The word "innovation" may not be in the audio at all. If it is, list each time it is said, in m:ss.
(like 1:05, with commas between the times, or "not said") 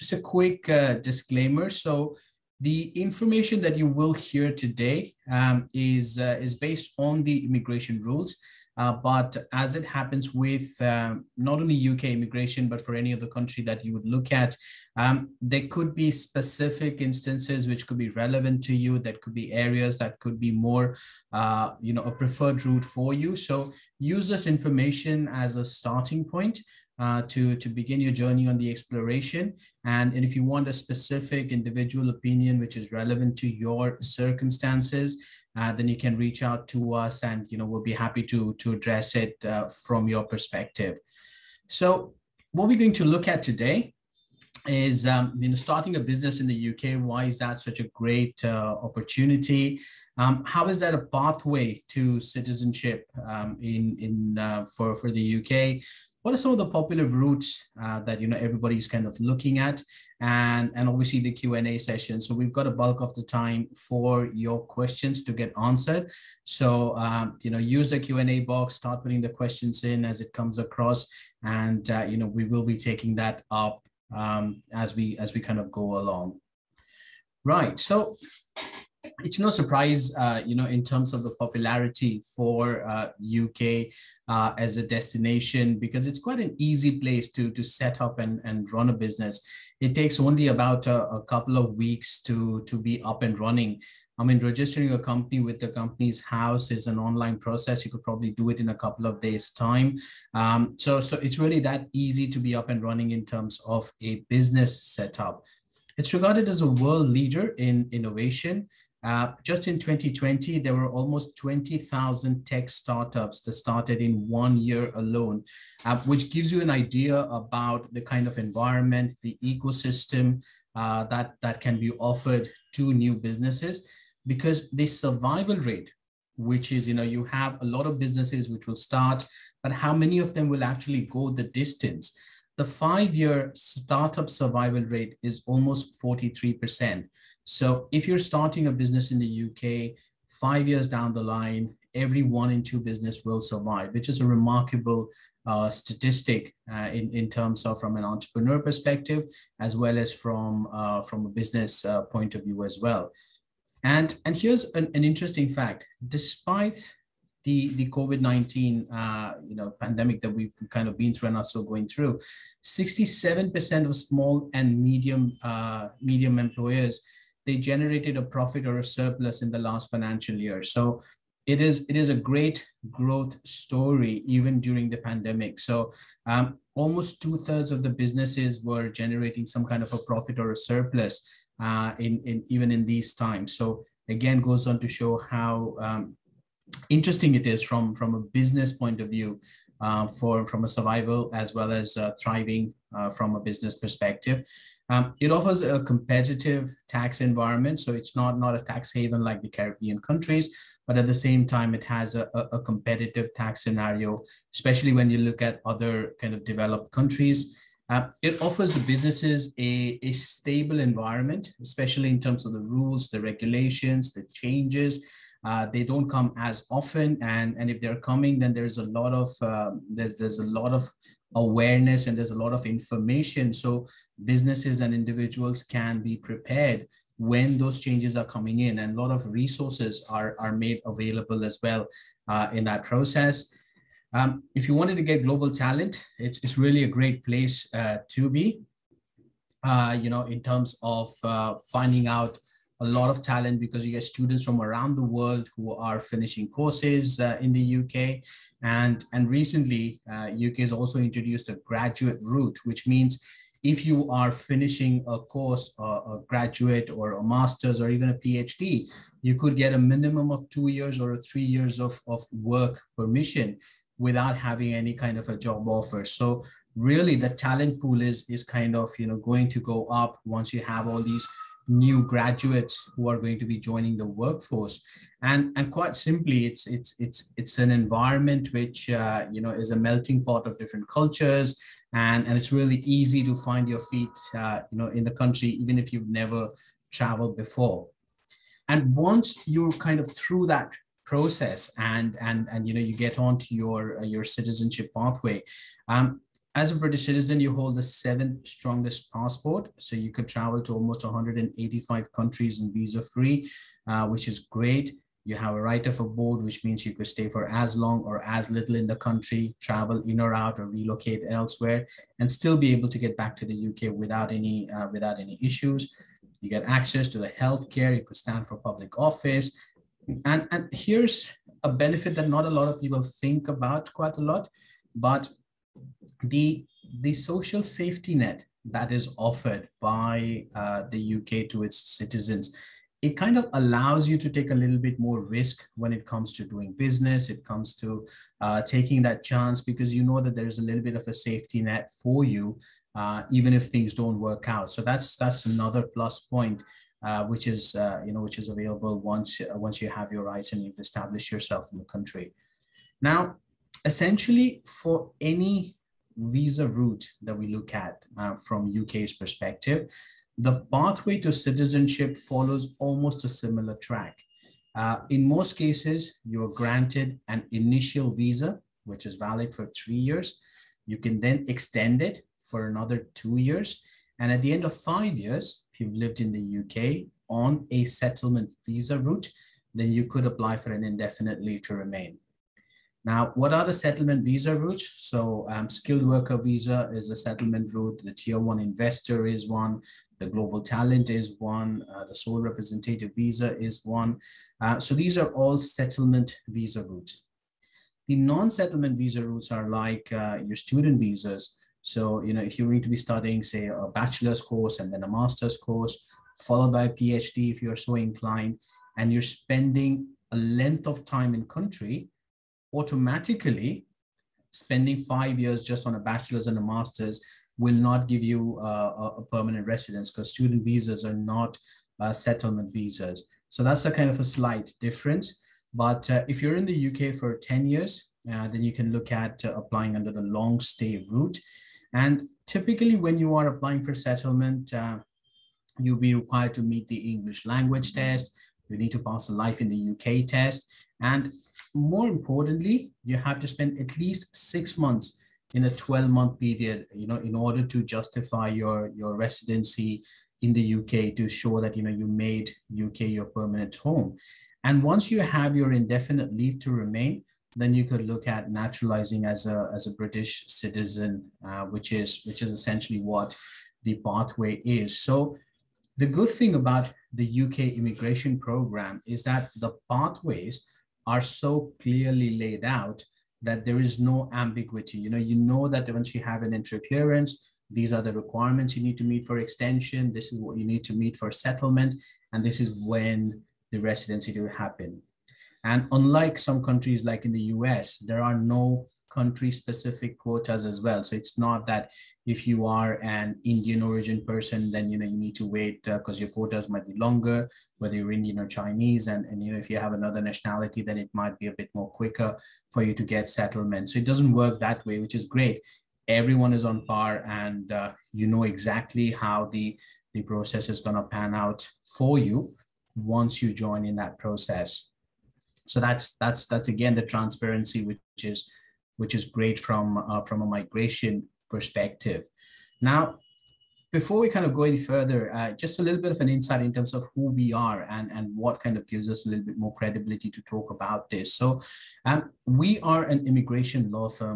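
1:47.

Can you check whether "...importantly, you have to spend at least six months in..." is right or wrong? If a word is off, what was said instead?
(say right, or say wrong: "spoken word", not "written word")
right.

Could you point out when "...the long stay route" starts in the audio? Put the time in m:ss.
7:10.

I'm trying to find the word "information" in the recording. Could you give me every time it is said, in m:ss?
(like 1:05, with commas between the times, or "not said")
0:02, 0:24, 3:42.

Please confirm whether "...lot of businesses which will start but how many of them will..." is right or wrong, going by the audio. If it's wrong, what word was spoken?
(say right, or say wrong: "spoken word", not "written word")
right.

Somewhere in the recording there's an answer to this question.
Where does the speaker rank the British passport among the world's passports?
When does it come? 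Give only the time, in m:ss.
4:57.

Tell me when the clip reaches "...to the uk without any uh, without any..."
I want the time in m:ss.
5:13.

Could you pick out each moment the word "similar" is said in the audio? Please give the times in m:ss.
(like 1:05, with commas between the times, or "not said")
6:03.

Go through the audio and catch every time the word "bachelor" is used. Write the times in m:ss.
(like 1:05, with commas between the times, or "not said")
6:43, 6:55.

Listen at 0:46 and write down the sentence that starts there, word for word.
Why is that such a great uh, opportunity?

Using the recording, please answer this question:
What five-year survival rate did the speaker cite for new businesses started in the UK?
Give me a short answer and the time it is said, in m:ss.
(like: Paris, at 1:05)
43%, at 2:15.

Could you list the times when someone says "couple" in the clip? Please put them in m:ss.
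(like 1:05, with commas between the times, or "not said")
1:31, 1:38.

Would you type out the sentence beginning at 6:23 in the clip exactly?
Now, what are the settlement visa routes?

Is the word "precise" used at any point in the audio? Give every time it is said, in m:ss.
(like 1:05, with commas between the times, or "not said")
not said.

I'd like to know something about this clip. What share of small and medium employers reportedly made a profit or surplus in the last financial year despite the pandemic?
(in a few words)
67%.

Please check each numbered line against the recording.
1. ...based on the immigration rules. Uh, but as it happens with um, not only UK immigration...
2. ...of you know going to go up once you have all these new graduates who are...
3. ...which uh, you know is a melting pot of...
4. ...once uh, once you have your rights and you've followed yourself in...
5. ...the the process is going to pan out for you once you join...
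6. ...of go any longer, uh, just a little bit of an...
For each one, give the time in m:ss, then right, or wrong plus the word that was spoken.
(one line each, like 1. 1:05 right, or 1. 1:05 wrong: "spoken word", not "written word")
1. 0:06 right
2. 4:28 right
3. 4:38 right
4. 5:48 wrong: "established", not "followed"
5. 8:29 right
6. 8:44 wrong: "further", not "longer".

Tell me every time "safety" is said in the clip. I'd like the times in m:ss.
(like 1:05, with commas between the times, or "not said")
5:27, 5:41.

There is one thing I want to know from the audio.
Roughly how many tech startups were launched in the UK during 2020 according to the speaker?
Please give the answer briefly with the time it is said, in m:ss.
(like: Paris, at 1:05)
20,000, at 1:50.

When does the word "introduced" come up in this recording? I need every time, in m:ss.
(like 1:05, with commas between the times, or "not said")
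4:10.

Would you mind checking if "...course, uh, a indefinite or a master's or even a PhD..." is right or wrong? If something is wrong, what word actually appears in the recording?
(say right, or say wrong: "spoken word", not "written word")
wrong: "graduate", not "indefinite".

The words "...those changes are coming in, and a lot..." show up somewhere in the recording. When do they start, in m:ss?
3:47.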